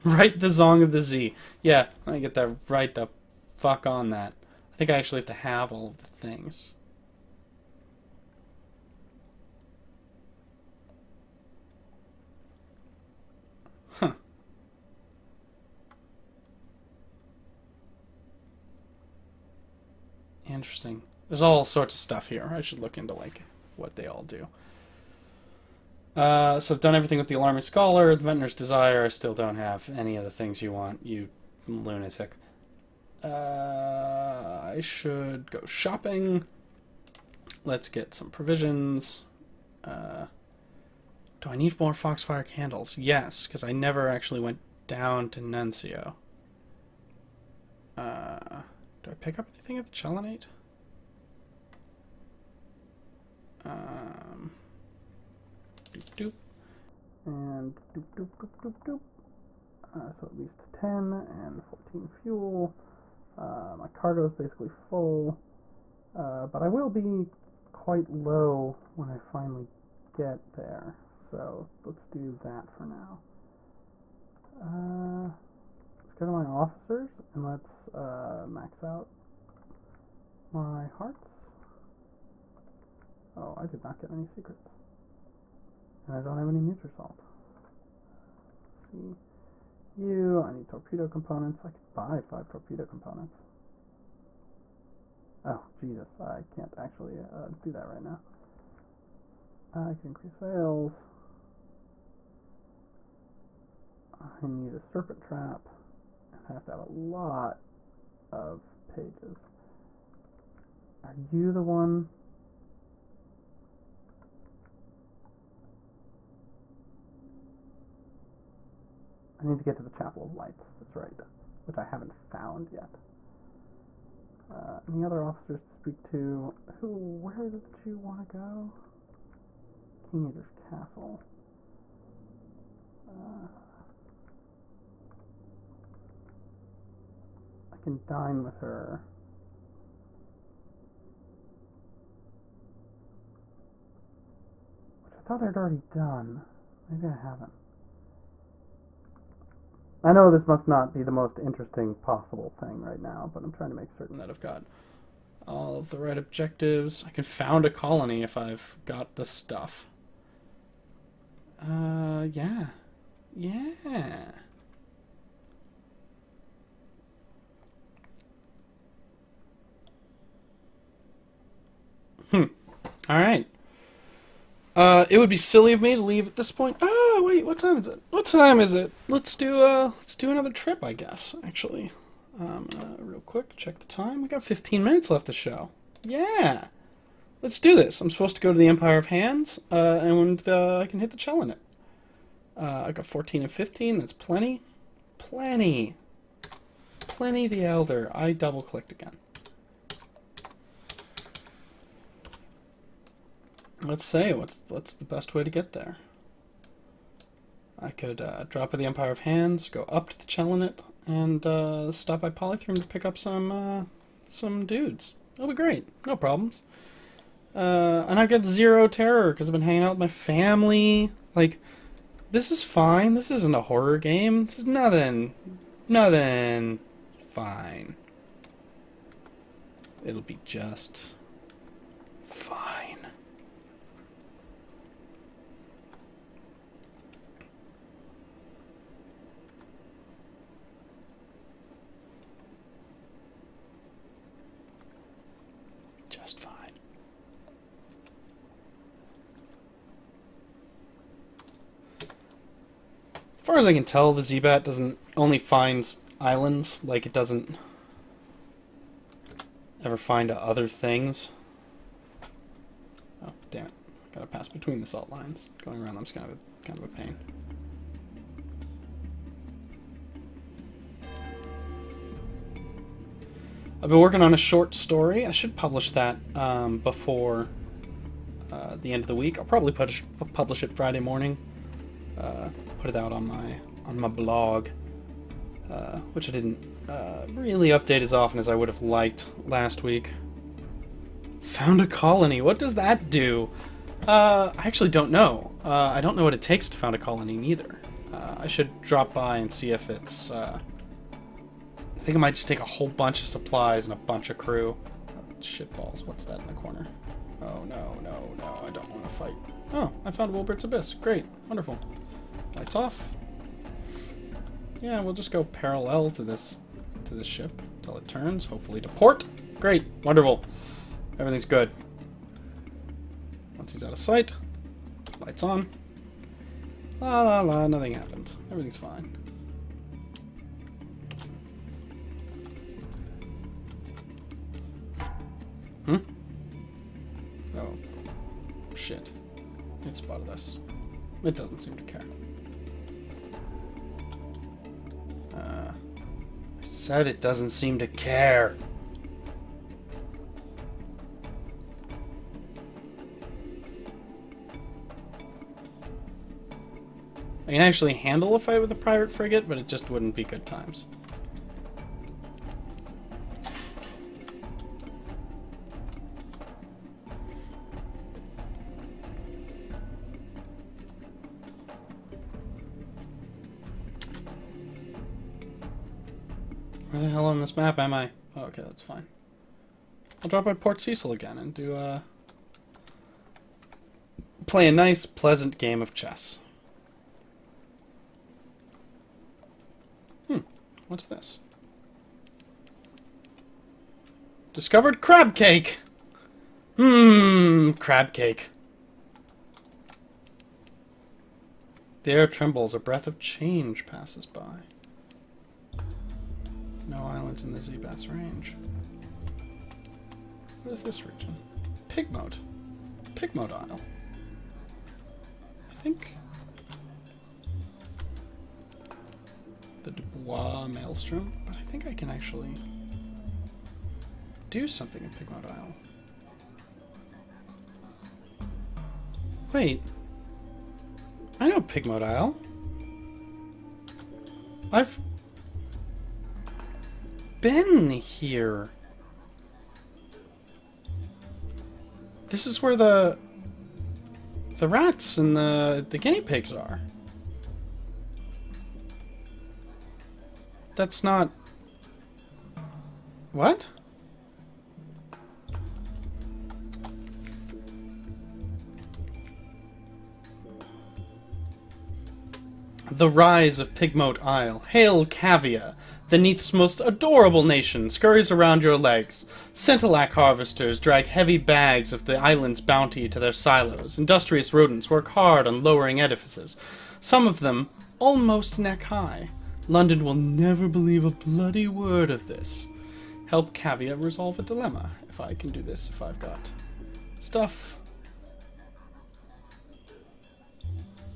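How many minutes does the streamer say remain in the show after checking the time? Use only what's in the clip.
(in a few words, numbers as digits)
15.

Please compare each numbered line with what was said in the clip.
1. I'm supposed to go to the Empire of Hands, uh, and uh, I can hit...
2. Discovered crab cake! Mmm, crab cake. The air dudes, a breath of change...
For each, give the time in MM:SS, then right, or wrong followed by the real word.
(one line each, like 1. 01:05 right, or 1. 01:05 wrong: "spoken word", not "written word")
1. 03:08 right
2. 06:34 wrong: "trembles", not "dudes".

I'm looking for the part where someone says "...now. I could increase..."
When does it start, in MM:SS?
01:38.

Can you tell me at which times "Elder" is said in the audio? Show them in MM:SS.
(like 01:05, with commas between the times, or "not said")
03:17.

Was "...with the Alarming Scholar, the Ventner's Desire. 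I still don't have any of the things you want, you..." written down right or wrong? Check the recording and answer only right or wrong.
right.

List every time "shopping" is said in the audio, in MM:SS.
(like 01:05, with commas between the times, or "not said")
00:35.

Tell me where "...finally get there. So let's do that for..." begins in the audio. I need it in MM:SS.
01:09.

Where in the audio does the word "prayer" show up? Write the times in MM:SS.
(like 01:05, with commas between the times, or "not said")
not said.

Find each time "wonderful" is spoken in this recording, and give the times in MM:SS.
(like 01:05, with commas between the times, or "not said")
05:11, 05:20.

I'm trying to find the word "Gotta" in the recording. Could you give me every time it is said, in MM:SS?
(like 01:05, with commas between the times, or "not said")
04:24.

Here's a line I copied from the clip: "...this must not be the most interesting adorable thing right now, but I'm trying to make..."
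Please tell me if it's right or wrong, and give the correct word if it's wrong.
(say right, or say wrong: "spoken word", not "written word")
wrong: "possible", not "adorable".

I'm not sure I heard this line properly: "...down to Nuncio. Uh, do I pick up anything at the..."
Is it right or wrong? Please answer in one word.
right.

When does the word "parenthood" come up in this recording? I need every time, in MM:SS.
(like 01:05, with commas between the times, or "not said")
not said.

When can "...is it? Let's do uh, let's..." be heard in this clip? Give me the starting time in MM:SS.
02:58.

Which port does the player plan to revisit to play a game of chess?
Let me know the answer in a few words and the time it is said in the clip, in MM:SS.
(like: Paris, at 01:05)
Port Cecil, at 06:20.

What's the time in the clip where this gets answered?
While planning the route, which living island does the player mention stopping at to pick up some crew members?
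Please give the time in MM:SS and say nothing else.
03:32.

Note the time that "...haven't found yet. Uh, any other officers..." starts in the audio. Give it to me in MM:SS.
02:01.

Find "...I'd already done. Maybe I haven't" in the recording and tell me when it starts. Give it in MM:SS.
02:25.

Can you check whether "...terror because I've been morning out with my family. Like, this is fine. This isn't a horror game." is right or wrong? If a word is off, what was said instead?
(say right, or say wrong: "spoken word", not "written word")
wrong: "hanging", not "morning".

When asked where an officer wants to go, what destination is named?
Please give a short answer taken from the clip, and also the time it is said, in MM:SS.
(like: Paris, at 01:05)
King Eater's Castle, at 02:10.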